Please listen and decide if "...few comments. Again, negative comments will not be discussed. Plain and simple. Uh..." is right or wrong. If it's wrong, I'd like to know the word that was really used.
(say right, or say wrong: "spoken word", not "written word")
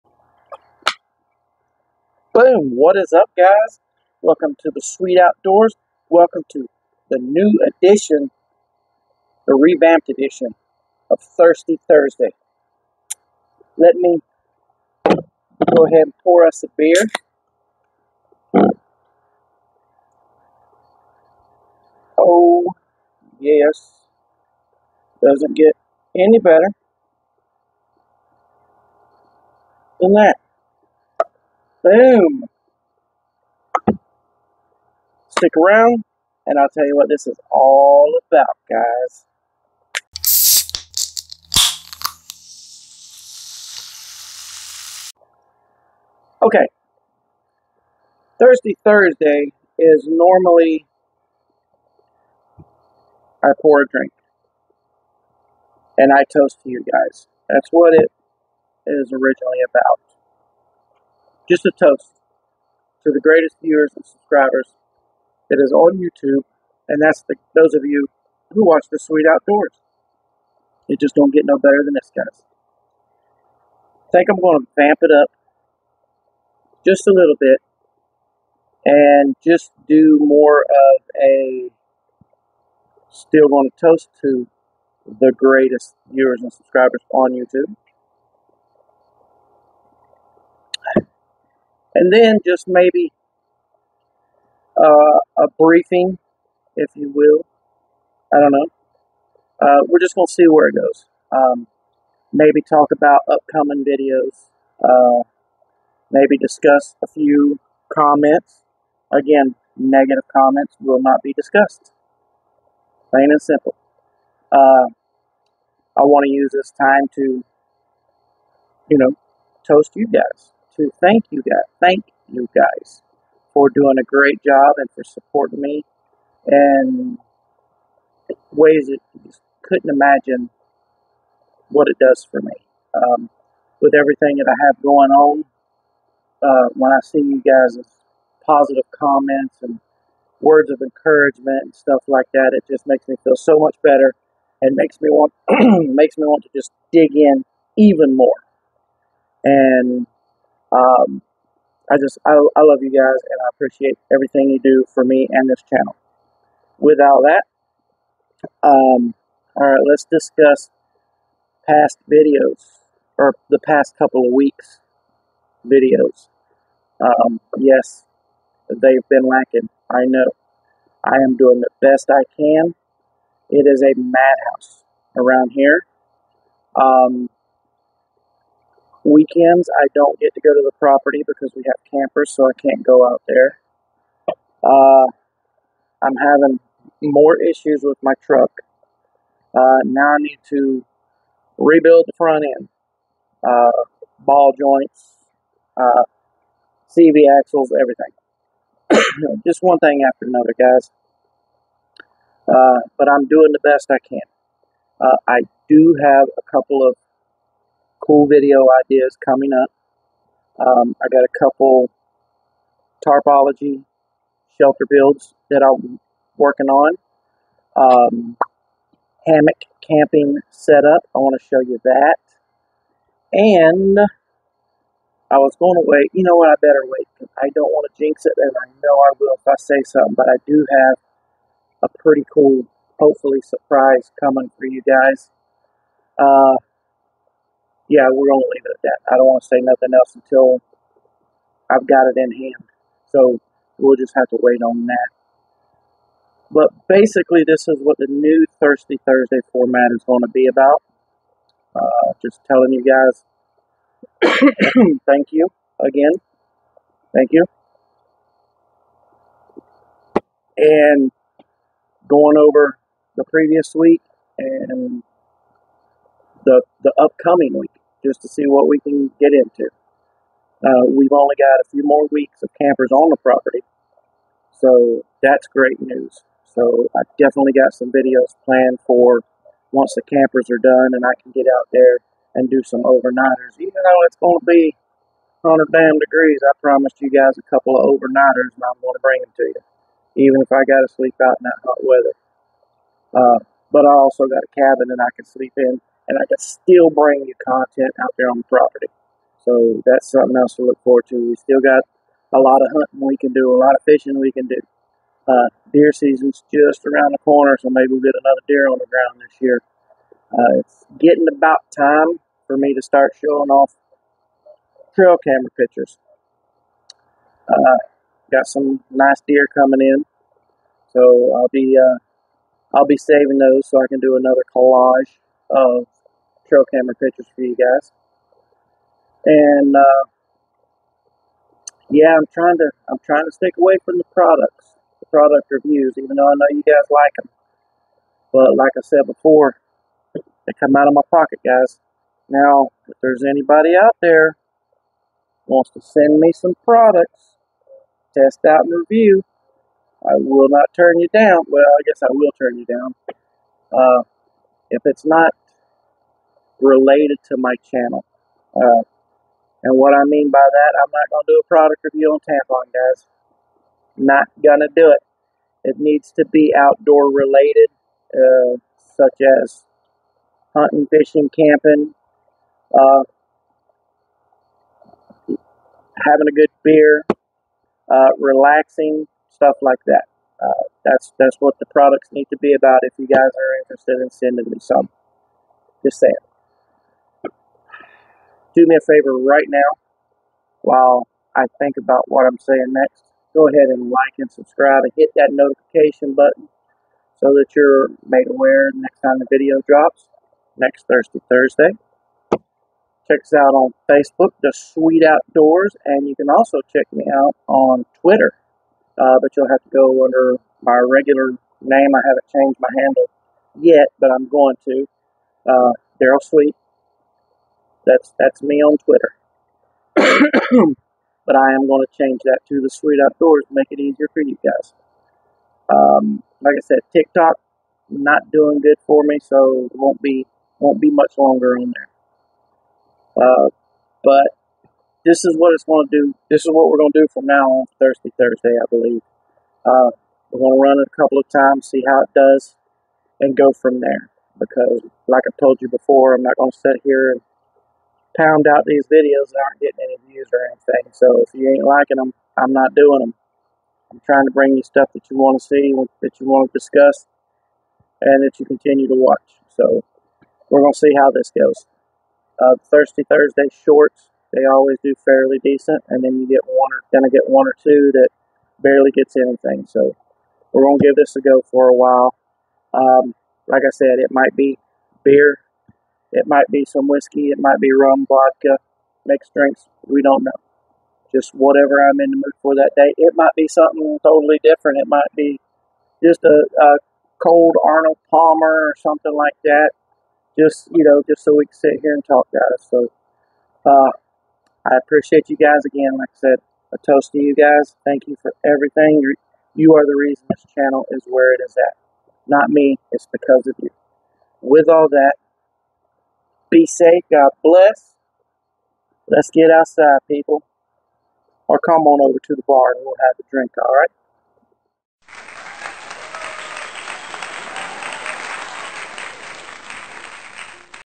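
right.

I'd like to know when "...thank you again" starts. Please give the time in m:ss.
4:15.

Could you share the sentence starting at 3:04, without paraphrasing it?
Uh, I'm having more issues with my truck.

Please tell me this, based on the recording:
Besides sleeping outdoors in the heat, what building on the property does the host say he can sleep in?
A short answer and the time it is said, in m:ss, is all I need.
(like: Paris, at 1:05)
A cabin, at 4:54.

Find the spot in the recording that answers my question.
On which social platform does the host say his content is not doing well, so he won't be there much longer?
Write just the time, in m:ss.
7:06.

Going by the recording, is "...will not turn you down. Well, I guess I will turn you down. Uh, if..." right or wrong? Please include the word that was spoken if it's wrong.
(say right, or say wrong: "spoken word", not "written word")
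right.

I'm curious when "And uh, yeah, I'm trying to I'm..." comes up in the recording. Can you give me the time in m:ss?
5:29.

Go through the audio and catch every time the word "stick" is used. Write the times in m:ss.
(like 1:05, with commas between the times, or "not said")
0:35, 5:33.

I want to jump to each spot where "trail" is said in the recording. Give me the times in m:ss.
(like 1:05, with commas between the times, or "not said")
5:14, 5:26.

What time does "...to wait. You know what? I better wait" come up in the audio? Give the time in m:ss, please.
3:45.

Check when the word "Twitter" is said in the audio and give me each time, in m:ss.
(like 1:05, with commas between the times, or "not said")
6:48, 6:58.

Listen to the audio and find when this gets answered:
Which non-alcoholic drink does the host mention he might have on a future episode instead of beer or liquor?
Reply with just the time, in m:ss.
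8:07.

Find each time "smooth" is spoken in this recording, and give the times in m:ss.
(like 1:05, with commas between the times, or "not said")
not said.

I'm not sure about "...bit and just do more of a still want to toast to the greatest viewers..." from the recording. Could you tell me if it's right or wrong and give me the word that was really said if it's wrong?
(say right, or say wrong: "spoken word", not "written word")
right.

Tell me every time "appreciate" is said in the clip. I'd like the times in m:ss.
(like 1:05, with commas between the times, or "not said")
2:33, 8:14.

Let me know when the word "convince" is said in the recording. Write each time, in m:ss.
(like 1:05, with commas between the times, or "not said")
not said.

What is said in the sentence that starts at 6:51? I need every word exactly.
I haven't changed my handle yet, but I'm going to.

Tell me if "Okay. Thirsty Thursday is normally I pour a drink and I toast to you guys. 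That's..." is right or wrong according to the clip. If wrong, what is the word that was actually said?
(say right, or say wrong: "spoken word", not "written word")
right.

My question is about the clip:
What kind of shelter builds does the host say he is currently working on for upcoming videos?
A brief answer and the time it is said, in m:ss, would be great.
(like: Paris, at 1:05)
Tarpology shelter builds, at 3:33.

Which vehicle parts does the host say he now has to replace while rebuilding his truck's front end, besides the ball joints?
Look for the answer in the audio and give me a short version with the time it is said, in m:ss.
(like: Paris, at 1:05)
CV axles, at 3:16.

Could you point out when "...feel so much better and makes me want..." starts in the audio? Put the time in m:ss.
2:23.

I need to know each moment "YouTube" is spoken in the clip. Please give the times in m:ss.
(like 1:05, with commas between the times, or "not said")
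1:05, 1:27.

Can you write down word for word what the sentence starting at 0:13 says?
Let me go ahead and pour us a beer.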